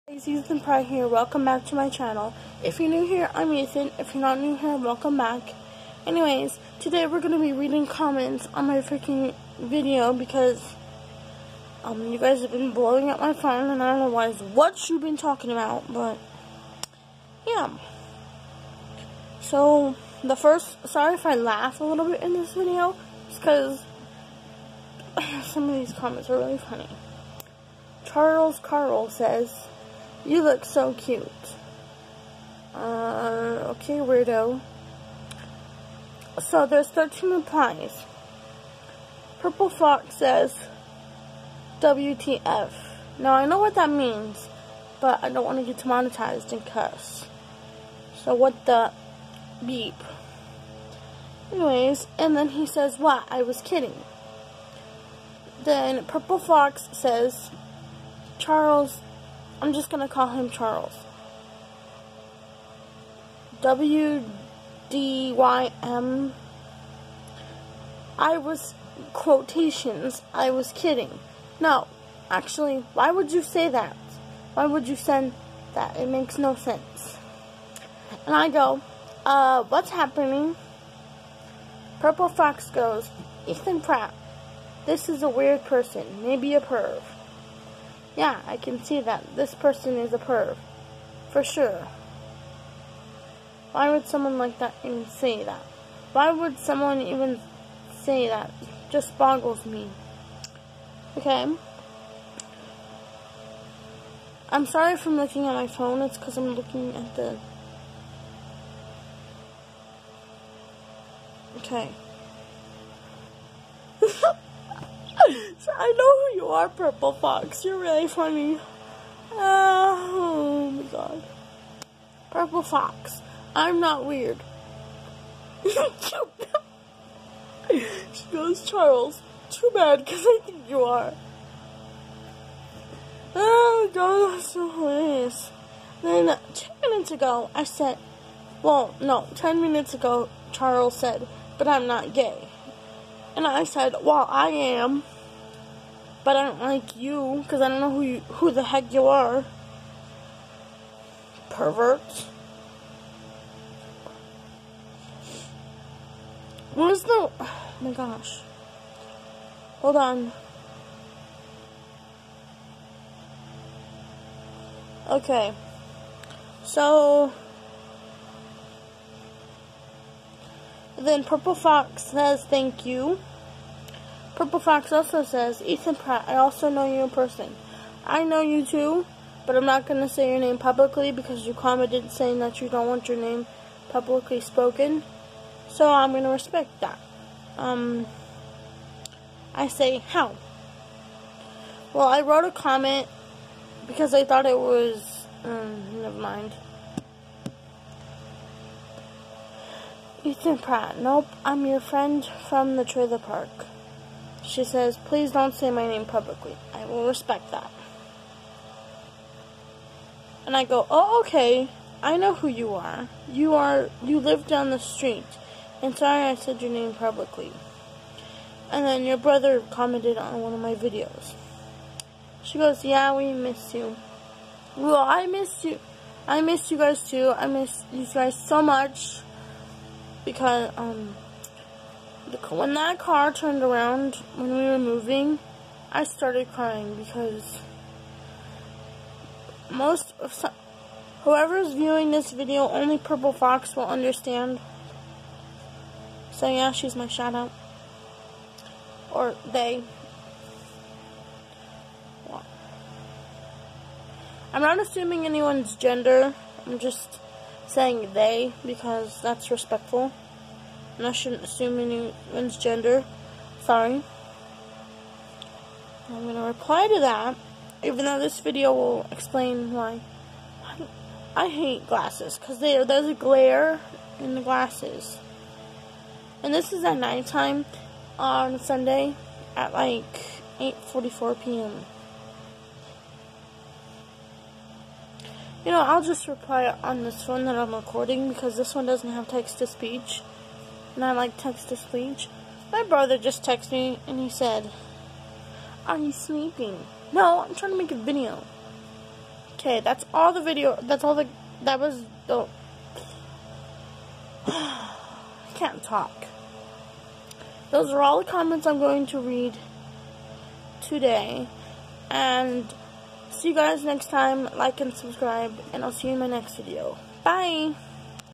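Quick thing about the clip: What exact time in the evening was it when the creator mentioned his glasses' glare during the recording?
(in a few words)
8:44 p.m.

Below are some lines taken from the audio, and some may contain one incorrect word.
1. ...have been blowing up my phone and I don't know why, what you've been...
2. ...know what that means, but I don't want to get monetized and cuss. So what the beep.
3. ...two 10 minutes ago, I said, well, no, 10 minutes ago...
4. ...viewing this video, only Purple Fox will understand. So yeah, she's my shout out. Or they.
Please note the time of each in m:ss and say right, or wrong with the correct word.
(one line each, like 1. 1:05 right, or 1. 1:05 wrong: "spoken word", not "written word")
1. 0:12 right
2. 0:43 right
3. 2:16 right
4. 4:01 right.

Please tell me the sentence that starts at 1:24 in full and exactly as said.
This is a weird person, maybe a perv.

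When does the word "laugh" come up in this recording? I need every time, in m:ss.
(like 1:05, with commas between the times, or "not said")
0:21.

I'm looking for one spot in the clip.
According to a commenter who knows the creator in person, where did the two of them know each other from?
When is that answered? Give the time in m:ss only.
3:22.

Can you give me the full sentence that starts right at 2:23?
And I said, well, I am but I don't like you because I don't know who you, who the heck you are.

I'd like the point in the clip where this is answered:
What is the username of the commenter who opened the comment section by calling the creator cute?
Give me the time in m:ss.
0:28.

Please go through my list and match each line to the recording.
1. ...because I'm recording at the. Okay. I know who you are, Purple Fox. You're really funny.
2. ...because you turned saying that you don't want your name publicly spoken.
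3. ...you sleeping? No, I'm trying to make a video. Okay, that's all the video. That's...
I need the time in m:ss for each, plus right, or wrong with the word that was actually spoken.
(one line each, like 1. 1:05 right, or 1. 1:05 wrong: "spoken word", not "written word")
1. 1:46 wrong: "looking", not "recording"
2. 3:01 wrong: "commented", not "turned"
3. 4:55 right.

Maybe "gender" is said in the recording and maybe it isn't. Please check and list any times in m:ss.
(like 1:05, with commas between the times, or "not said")
4:15, 4:22.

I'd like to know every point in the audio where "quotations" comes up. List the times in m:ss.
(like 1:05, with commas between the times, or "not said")
1:09.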